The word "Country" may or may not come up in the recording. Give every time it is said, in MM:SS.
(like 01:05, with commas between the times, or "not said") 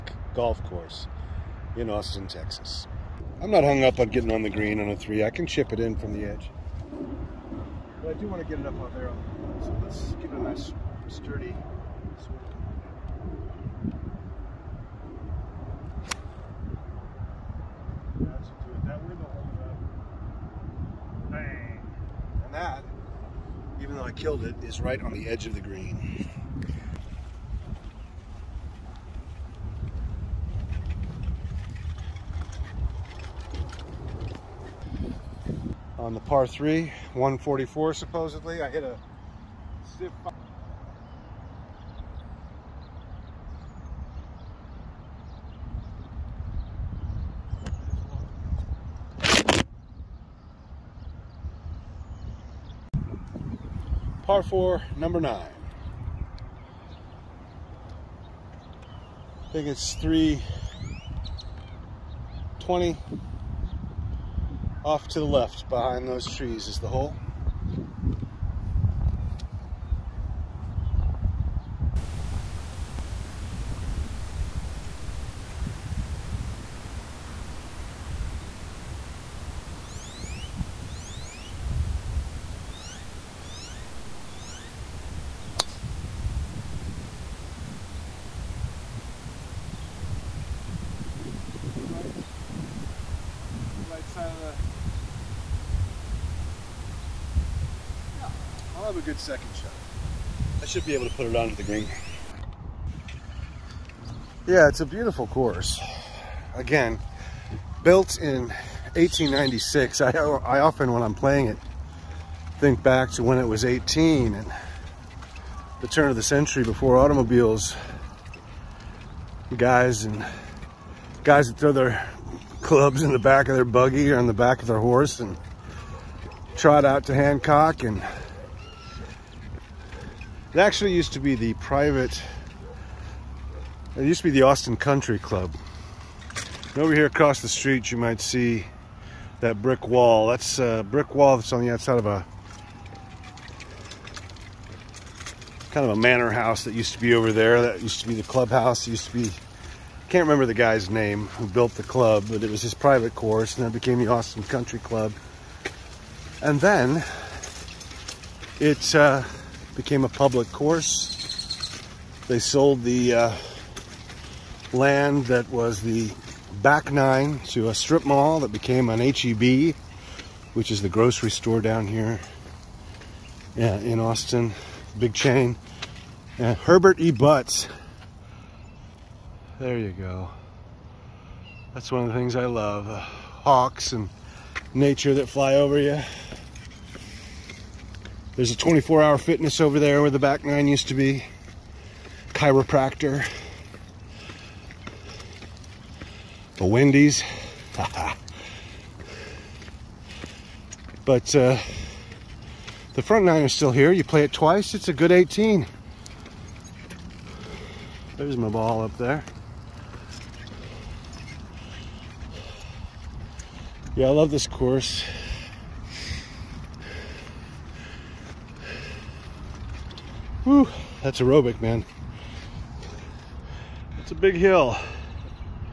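02:14, 02:34.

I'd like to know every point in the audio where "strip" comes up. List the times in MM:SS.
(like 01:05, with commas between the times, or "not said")
02:47.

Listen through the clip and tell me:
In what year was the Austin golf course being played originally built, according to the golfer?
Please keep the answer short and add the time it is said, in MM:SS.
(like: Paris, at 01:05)
1896, at 01:48.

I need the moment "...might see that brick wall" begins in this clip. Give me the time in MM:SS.
02:17.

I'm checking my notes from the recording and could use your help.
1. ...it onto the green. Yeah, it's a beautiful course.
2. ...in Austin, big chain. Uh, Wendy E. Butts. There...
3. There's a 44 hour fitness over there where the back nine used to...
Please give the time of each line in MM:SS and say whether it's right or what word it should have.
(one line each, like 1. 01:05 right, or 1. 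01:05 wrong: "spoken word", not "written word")
1. 01:41 right
2. 02:53 wrong: "Herbert", not "Wendy"
3. 03:08 wrong: "24", not "44".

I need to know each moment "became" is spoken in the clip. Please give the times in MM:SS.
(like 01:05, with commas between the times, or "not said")
02:33, 02:39, 02:48.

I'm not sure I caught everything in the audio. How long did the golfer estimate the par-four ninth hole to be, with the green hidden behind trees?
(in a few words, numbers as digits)
320.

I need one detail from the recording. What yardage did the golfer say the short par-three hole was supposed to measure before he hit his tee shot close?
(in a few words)
144.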